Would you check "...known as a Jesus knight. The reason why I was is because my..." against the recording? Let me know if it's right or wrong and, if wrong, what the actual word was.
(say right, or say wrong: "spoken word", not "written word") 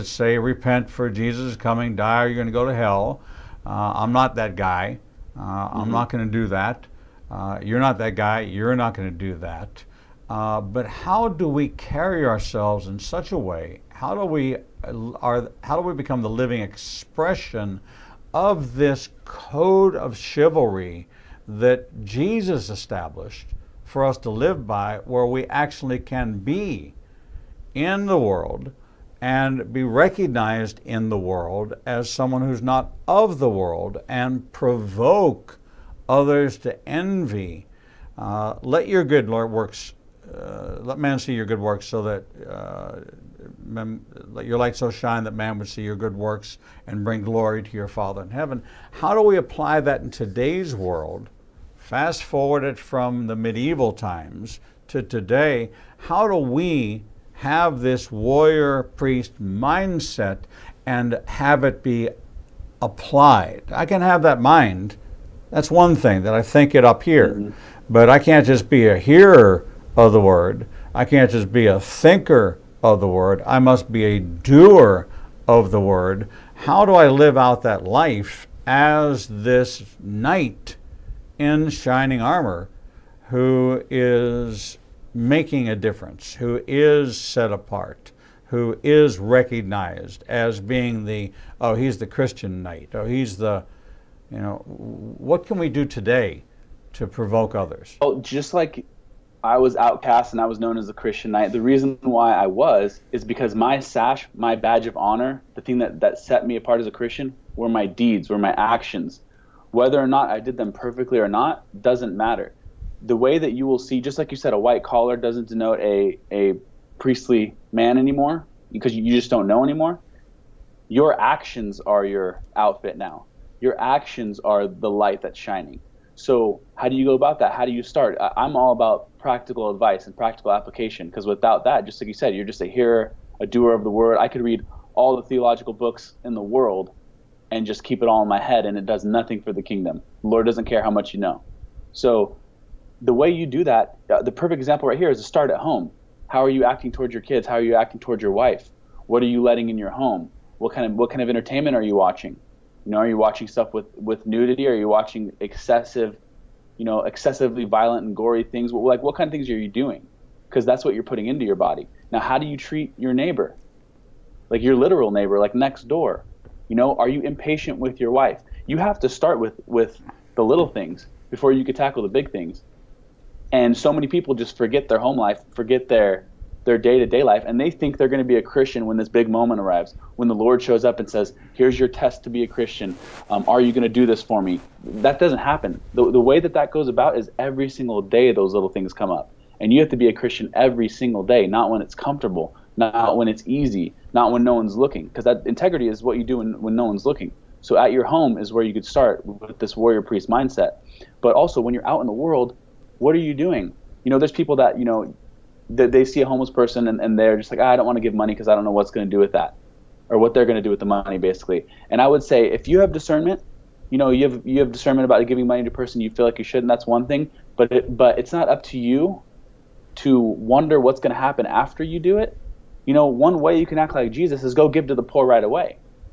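wrong: "Christian", not "Jesus".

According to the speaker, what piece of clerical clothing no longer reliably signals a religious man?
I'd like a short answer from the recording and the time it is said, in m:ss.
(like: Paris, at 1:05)
white collar, at 1:54.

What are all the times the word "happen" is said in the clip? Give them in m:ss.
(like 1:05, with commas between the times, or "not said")
3:05, 3:41.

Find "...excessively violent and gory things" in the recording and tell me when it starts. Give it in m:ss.
2:37.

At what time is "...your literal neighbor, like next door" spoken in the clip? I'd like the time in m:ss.
2:44.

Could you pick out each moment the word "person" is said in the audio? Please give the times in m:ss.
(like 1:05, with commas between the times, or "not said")
3:26, 3:35.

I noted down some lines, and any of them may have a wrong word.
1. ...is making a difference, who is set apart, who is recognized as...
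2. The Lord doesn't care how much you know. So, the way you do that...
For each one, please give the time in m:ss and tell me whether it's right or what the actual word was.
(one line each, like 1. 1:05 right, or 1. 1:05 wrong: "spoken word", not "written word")
1. 1:23 right
2. 2:20 right.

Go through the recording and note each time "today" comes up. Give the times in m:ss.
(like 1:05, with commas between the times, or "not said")
0:50, 0:55, 1:35.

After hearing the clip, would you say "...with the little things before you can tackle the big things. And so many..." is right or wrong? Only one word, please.
right.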